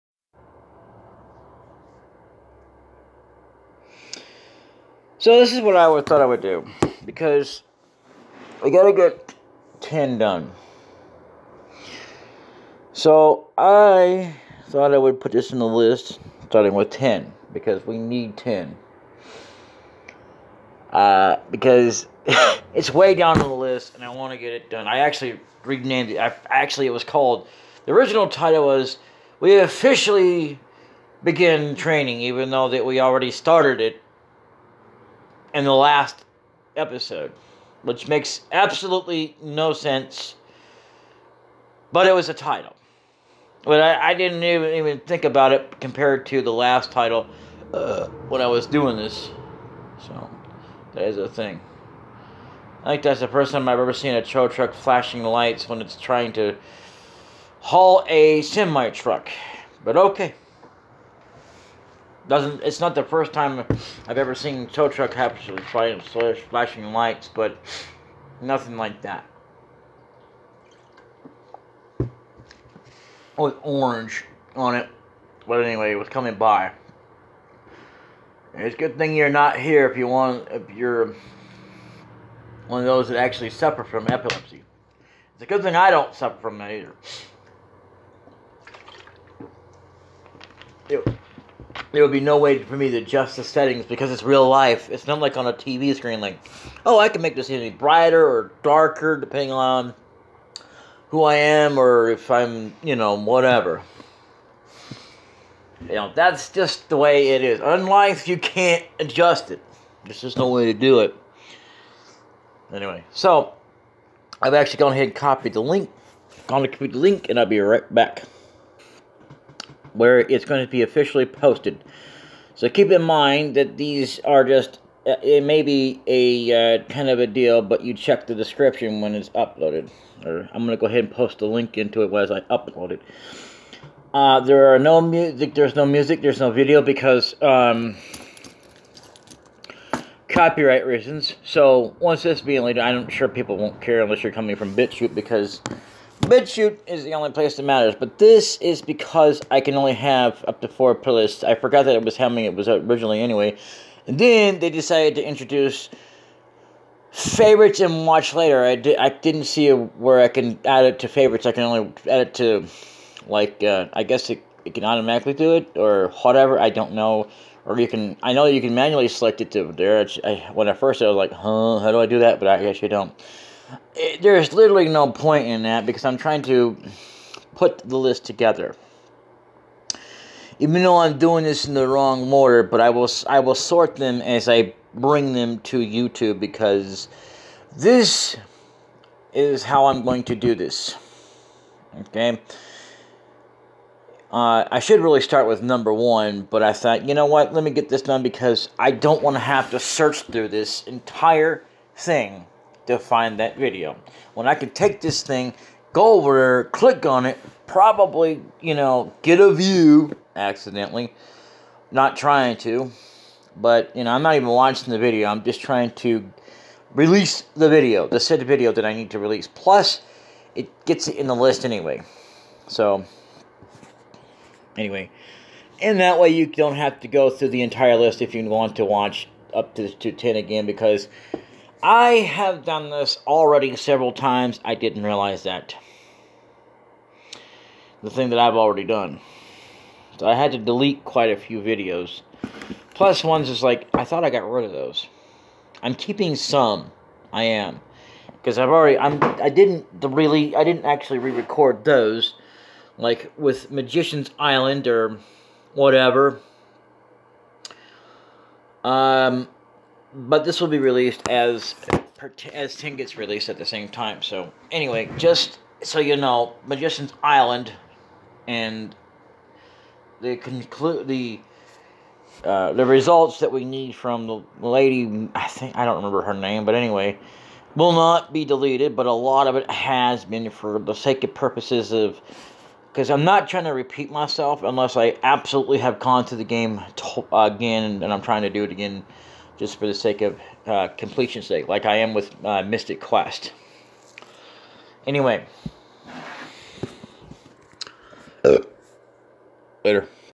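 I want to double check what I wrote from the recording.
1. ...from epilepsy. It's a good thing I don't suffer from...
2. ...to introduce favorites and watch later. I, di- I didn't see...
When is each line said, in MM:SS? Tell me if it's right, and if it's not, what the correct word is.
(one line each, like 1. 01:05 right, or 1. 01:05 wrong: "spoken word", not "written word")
1. 01:23 right
2. 02:35 right.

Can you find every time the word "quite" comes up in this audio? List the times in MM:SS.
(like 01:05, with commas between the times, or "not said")
04:01.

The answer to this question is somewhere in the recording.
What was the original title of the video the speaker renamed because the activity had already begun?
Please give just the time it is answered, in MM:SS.
00:29.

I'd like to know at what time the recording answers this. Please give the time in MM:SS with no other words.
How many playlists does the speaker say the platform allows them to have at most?
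02:30.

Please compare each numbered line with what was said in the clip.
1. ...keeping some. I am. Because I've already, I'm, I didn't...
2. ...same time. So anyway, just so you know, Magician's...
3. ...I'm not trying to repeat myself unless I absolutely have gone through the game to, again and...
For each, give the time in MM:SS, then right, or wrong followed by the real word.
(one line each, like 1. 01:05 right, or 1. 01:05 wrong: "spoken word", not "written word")
1. 04:05 right
2. 04:23 right
3. 04:43 right.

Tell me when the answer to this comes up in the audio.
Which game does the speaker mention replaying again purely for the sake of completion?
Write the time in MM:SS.
04:52.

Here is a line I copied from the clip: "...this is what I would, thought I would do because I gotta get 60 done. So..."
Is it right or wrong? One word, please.
wrong.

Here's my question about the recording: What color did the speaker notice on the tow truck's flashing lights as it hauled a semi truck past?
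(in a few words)
orange.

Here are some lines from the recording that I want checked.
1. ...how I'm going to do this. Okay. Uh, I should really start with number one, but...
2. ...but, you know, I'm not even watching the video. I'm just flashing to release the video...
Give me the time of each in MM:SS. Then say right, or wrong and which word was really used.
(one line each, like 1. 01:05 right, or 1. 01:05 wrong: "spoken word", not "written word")
1. 03:09 right
2. 03:33 wrong: "trying", not "flashing".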